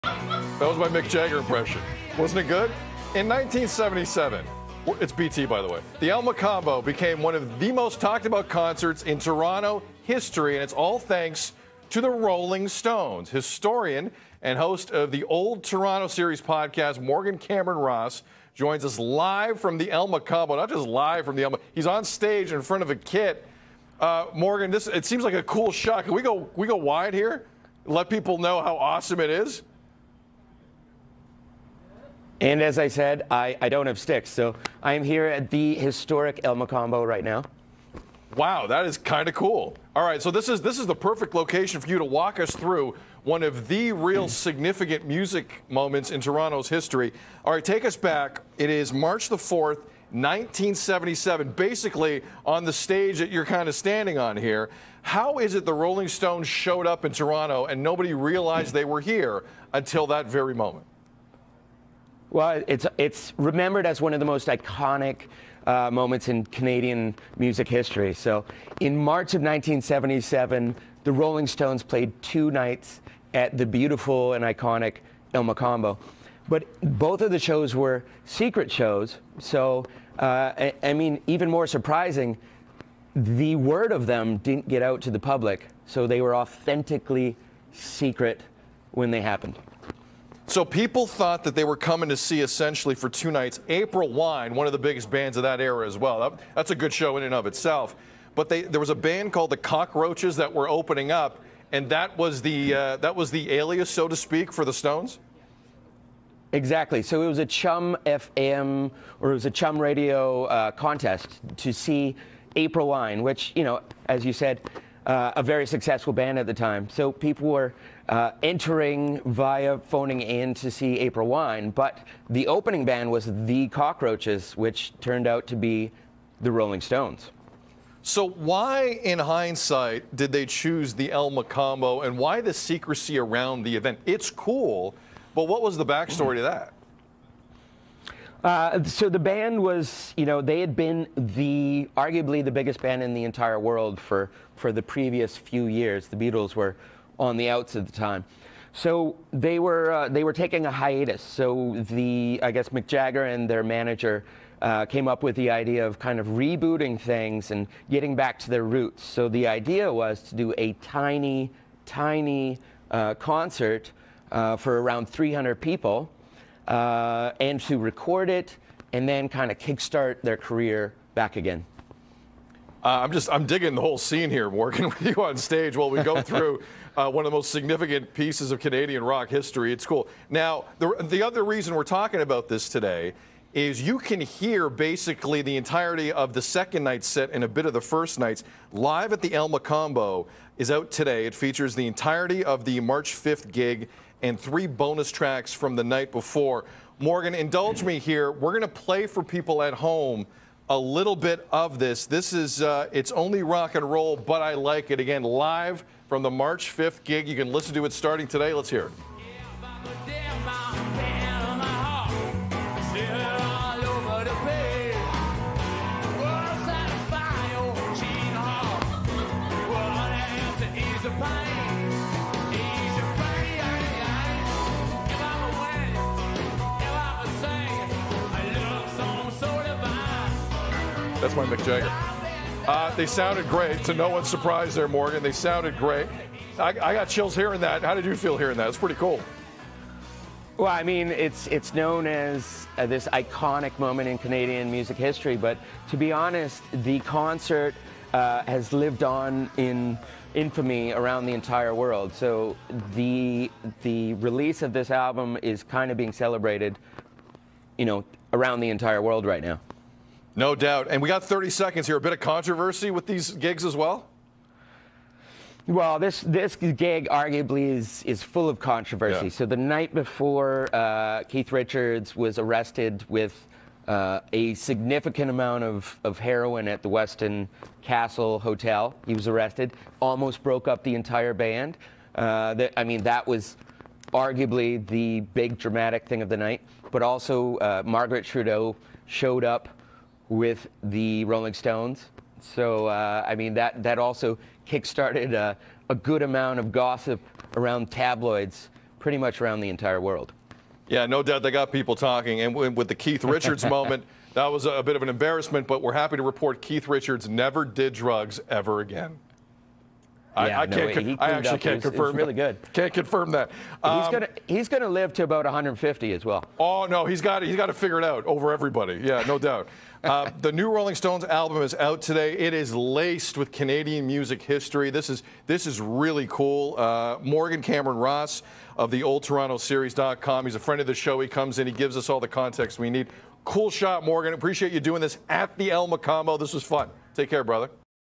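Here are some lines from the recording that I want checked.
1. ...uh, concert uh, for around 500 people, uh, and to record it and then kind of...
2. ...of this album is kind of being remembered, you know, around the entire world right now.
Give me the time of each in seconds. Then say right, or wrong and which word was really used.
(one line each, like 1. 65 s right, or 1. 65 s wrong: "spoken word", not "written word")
1. 162 s wrong: "300", not "500"
2. 254 s wrong: "celebrated", not "remembered".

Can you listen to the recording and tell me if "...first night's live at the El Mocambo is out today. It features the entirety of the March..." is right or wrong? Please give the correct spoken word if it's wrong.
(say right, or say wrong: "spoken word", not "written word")
right.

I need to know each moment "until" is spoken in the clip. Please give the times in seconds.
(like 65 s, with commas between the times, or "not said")
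59 s.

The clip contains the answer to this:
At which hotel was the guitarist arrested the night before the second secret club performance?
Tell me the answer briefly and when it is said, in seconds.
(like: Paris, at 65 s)
Westin Castle Hotel, at 276 s.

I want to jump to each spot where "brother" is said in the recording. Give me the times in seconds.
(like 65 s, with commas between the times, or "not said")
337 s.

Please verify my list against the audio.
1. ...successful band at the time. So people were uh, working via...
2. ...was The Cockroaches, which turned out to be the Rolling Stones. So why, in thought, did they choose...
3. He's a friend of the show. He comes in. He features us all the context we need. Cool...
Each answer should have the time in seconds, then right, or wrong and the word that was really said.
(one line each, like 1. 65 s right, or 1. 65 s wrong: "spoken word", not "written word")
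1. 115 s wrong: "entering", not "working"
2. 123 s wrong: "hindsight", not "thought"
3. 330 s wrong: "gives", not "features".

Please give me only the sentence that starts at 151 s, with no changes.
So the I guess Mick Jagger and their manager.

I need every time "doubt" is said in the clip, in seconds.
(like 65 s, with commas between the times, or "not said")
260 s, 301 s, 319 s.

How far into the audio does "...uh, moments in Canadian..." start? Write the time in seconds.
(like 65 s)
65 s.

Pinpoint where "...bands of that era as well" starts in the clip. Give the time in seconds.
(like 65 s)
95 s.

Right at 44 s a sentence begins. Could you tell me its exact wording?
significant music moments in Toronto's history.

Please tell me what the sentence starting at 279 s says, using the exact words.
Almost broke up the entire band.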